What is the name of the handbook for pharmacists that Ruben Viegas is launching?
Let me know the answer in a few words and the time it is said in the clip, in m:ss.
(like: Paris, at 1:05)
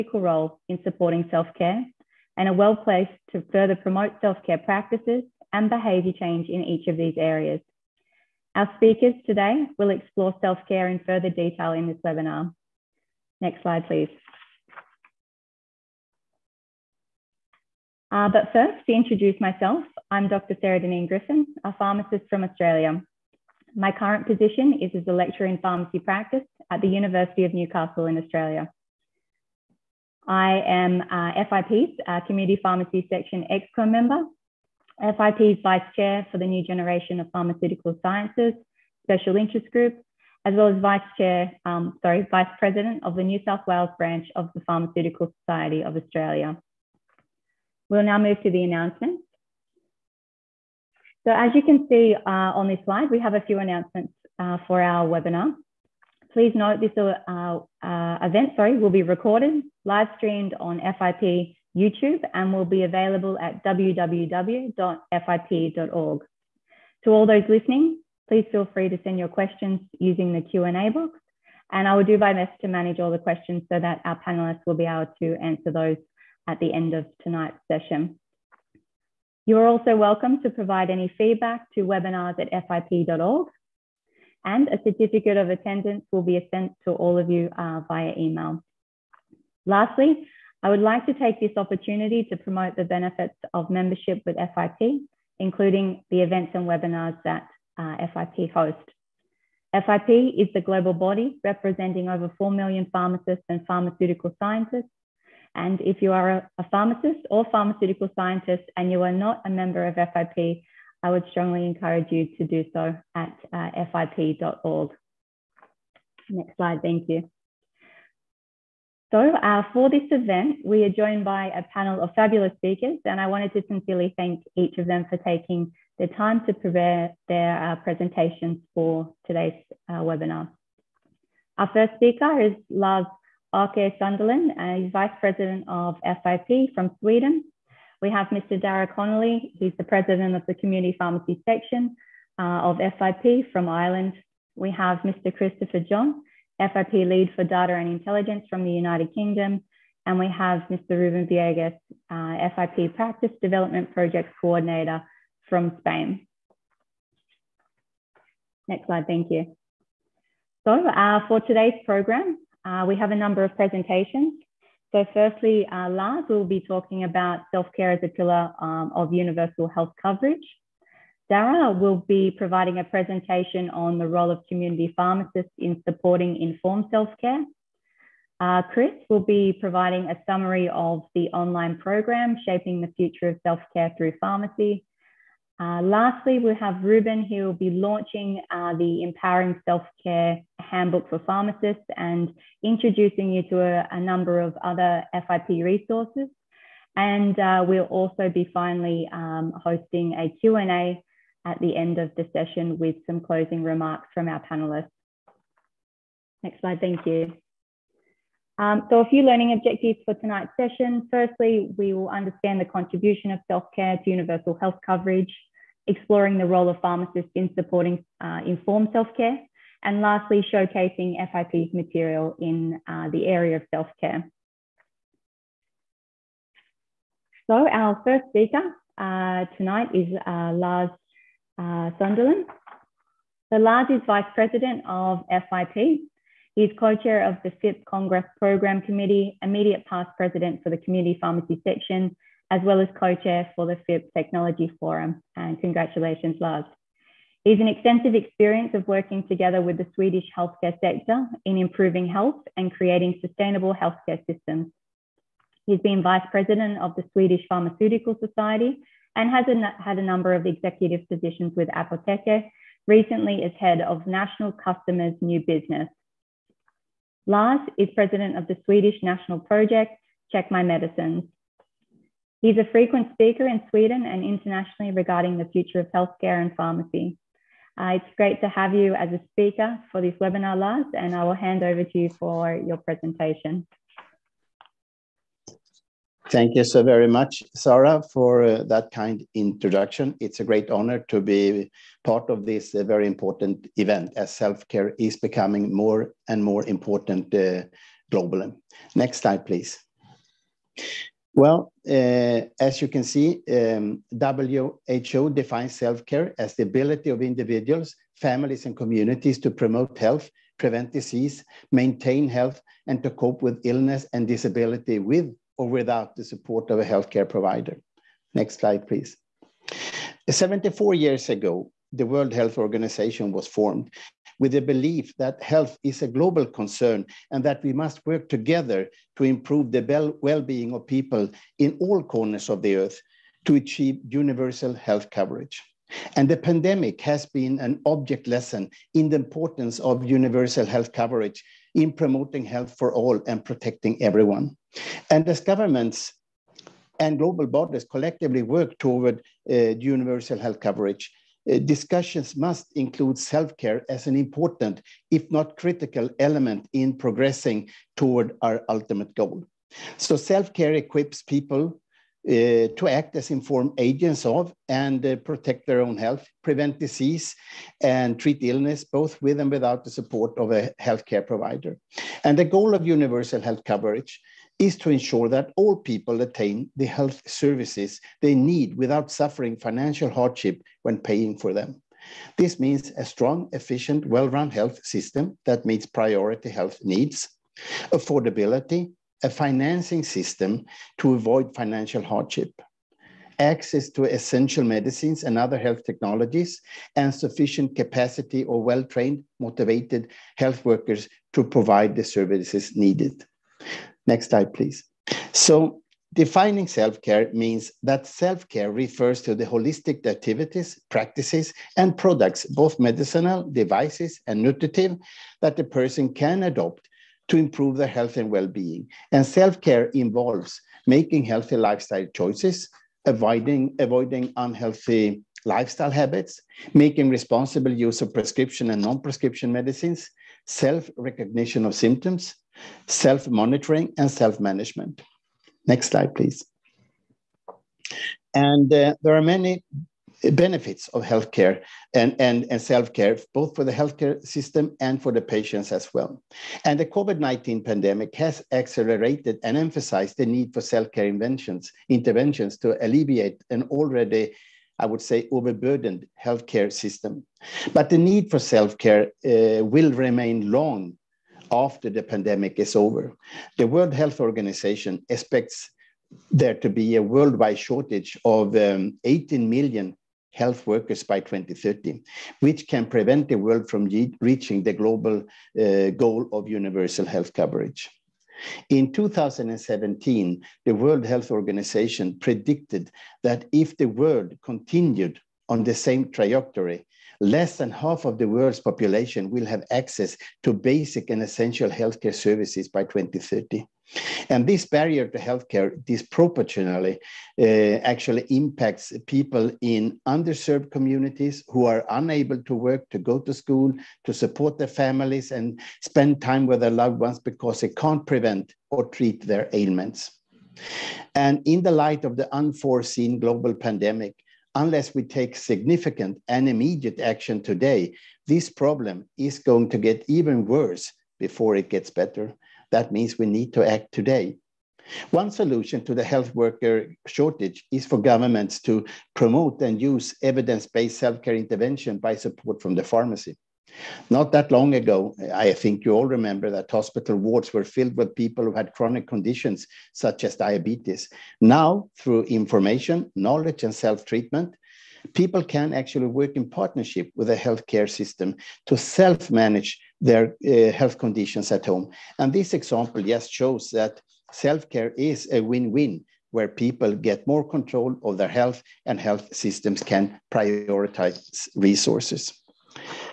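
Empowering Self Care Handbook, at 3:09.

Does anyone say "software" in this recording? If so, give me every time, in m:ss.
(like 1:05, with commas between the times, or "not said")
not said.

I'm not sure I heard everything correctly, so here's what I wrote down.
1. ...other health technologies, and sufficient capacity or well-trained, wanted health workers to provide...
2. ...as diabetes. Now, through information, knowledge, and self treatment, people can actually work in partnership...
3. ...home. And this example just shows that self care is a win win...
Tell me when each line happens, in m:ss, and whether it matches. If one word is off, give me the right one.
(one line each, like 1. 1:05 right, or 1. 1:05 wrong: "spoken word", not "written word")
1. 6:35 wrong: "motivated", not "wanted"
2. 9:00 right
3. 9:11 right.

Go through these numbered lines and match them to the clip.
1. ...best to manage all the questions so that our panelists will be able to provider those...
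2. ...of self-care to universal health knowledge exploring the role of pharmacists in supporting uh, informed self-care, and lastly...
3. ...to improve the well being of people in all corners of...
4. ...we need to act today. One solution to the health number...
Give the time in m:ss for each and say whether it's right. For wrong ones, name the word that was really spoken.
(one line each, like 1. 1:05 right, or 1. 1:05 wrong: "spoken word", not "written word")
1. 1:12 wrong: "answer", not "provider"
2. 3:33 wrong: "coverage", not "knowledge"
3. 5:29 right
4. 8:43 wrong: "worker", not "number".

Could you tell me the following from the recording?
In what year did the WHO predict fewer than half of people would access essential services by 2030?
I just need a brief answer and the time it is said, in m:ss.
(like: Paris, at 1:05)
2017, at 7:58.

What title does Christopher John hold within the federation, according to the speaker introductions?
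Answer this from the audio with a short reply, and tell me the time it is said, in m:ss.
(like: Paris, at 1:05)
Lead for Data and Intelligence, at 2:26.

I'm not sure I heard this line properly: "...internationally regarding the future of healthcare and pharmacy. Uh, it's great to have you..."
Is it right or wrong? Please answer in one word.
right.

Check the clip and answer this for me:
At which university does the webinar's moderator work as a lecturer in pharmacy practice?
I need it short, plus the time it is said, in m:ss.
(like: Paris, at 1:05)
University of Newcastle, at 0:26.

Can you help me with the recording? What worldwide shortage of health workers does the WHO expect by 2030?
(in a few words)
18 million.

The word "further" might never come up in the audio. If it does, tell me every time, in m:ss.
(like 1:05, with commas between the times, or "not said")
0:03, 0:11.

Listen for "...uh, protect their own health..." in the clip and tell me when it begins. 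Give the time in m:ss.
6:05.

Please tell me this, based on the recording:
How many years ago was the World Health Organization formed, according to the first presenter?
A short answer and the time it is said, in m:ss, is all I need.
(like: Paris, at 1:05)
74, at 5:20.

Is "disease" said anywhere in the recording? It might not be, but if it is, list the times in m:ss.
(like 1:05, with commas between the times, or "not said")
5:10, 6:06.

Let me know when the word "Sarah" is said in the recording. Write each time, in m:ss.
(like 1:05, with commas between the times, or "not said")
0:20, 4:47.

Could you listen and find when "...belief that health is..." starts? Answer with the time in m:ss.
5:24.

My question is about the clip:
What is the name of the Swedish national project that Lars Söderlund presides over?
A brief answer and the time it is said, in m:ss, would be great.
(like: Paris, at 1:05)
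Check My Medicines, at 4:30.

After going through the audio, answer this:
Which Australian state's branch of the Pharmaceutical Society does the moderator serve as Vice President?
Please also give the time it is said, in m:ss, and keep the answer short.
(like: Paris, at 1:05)
New South Wales, at 0:43.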